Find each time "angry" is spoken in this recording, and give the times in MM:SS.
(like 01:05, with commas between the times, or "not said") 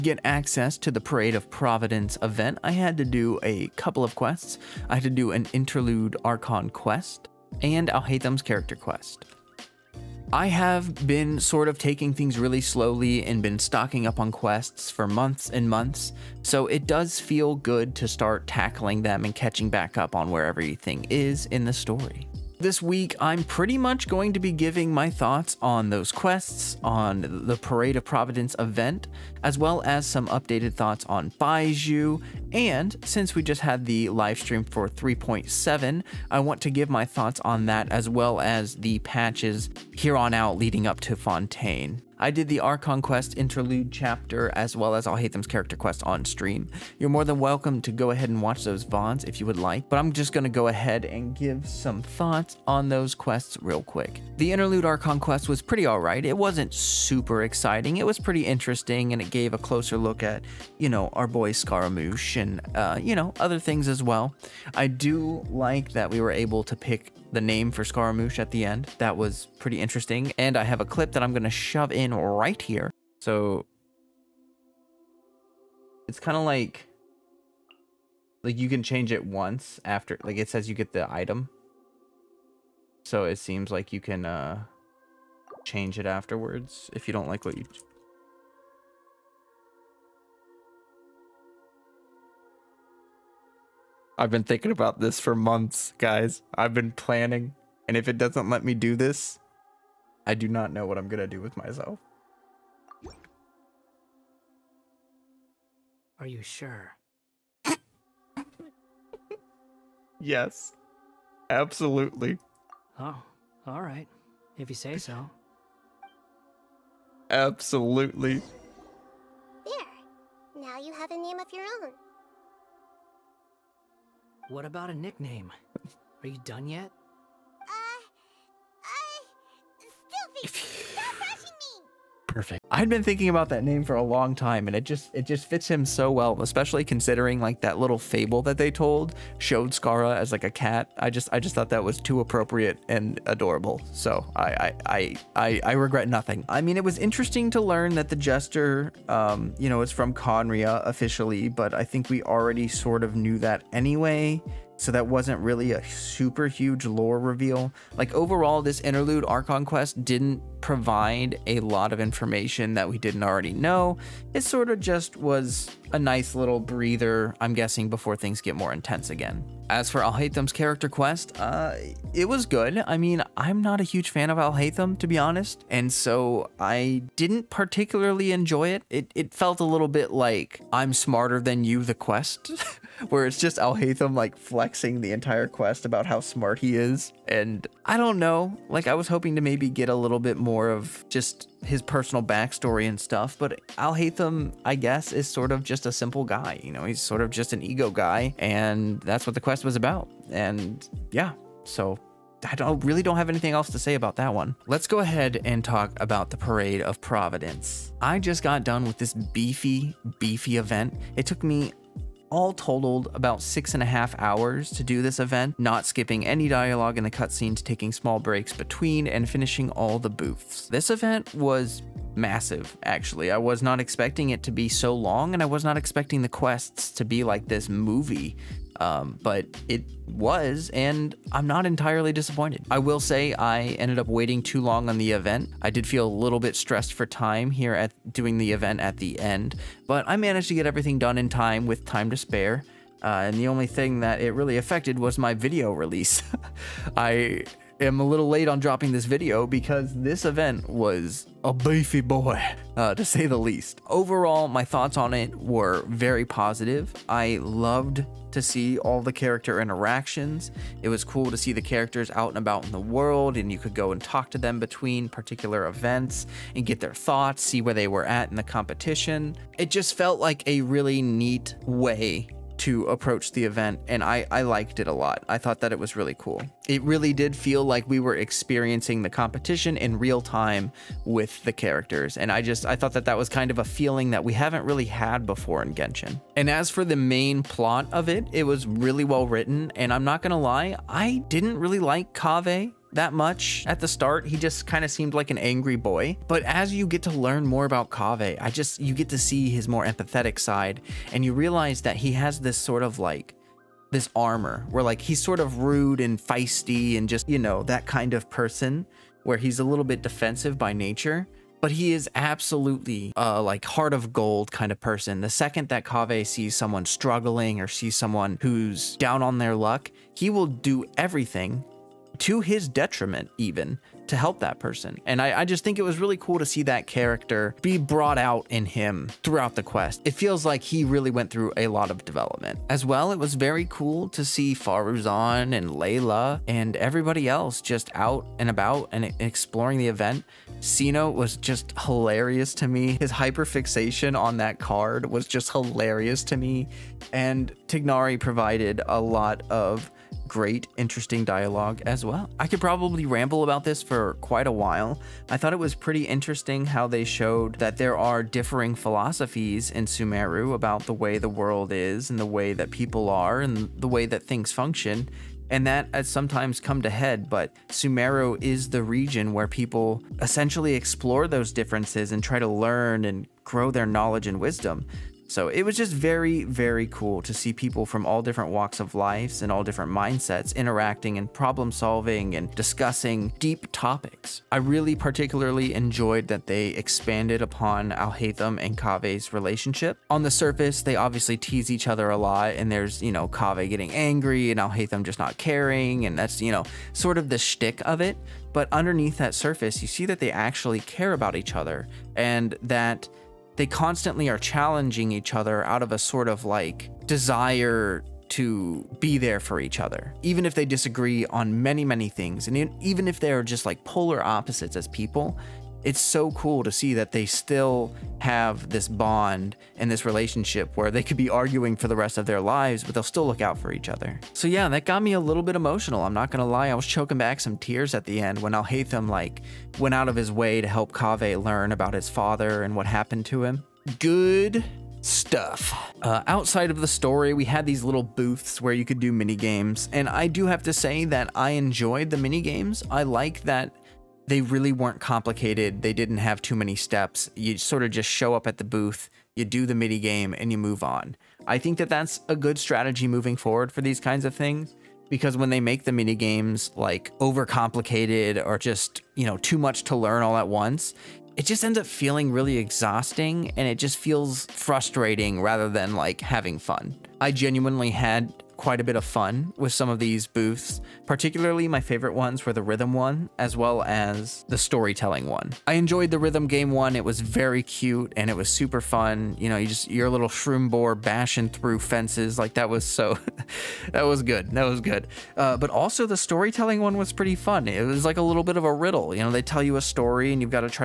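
04:55, 06:33.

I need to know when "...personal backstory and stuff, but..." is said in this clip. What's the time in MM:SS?
03:11.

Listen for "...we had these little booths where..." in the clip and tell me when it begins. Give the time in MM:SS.
07:17.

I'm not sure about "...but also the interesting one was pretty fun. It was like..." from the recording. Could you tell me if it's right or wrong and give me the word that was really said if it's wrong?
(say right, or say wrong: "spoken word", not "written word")
wrong: "storytelling", not "interesting".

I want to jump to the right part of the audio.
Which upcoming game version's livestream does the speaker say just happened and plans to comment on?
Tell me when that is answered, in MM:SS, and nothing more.
00:34.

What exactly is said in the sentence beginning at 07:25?
They didn't have too many steps.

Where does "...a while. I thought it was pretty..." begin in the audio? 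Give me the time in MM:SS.
05:54.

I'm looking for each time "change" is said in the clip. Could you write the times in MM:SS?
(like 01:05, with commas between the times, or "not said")
01:18, 01:25.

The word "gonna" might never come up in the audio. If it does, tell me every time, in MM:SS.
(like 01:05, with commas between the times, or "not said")
01:11, 07:06.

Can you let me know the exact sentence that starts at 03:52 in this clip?
I will say I ended up waiting too long on the event.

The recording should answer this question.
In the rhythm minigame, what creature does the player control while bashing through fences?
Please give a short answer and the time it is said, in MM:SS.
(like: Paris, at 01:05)
Shroom boar, at 08:00.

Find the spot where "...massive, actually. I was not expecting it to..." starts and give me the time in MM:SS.
03:42.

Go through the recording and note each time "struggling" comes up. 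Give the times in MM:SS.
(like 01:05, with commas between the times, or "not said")
05:16.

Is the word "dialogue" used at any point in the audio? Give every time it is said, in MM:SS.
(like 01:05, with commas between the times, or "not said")
03:36, 05:51.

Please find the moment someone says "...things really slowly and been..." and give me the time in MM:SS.
00:12.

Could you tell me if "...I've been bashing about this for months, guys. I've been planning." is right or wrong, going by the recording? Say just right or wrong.
wrong.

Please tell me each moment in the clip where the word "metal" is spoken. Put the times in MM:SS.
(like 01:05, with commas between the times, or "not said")
not said.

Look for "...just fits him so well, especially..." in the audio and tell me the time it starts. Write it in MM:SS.
02:15.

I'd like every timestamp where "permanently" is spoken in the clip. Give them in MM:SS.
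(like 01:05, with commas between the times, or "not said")
not said.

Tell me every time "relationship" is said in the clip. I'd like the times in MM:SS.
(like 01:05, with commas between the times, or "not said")
06:29, 07:00.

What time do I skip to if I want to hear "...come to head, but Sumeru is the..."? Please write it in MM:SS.
06:06.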